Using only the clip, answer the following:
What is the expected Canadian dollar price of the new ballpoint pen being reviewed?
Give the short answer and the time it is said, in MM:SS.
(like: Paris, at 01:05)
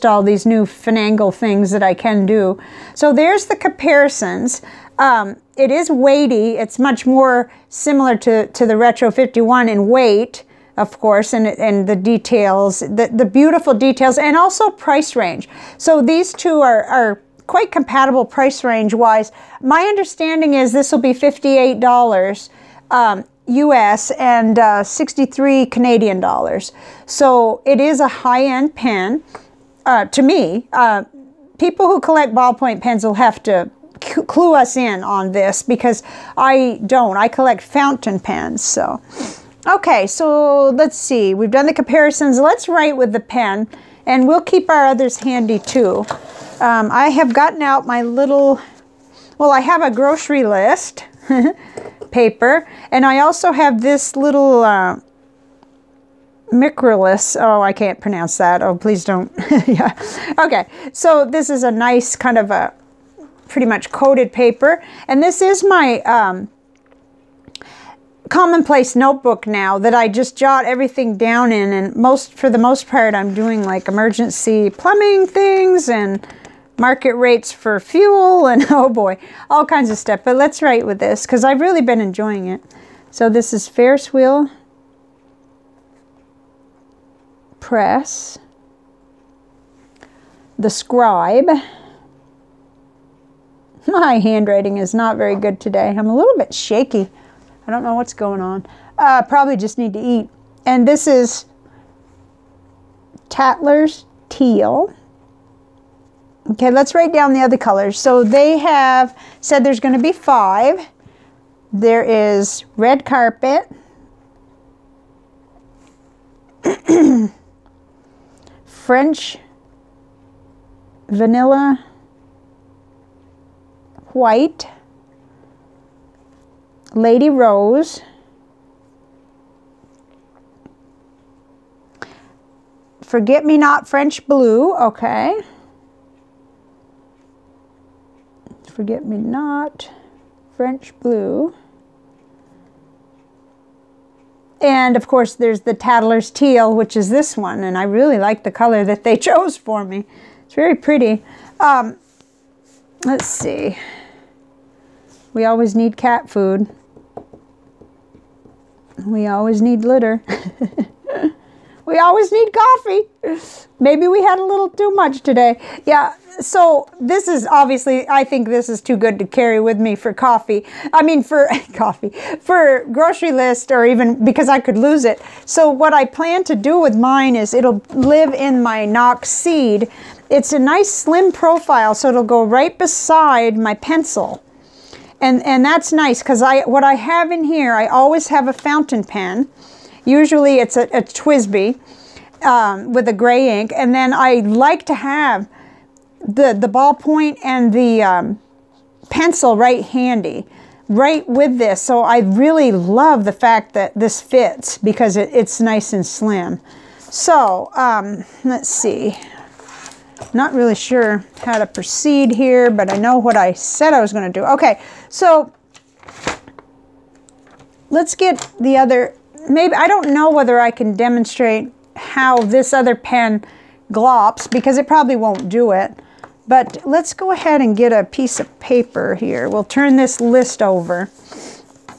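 63 Canadian dollars, at 00:24.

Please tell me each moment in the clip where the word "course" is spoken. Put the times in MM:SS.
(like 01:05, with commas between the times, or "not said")
00:10, 02:25.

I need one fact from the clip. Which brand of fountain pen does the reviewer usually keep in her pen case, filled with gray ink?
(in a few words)
TWSBI.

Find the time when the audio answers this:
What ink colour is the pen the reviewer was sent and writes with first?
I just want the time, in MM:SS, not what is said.
01:43.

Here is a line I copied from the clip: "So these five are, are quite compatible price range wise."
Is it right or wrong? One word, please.
wrong.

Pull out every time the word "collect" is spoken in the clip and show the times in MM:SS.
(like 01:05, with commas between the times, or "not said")
00:31, 00:37.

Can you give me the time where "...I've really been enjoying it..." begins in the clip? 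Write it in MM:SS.
01:21.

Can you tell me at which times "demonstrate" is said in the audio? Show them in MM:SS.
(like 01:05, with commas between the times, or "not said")
03:40.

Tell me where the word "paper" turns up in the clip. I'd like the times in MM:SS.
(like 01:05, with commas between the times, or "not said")
00:52, 01:04, 03:48.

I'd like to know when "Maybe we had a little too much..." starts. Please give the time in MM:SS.
02:43.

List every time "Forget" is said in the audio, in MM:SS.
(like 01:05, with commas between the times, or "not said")
02:13, 02:18.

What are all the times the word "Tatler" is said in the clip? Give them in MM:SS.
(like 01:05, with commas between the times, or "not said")
01:43.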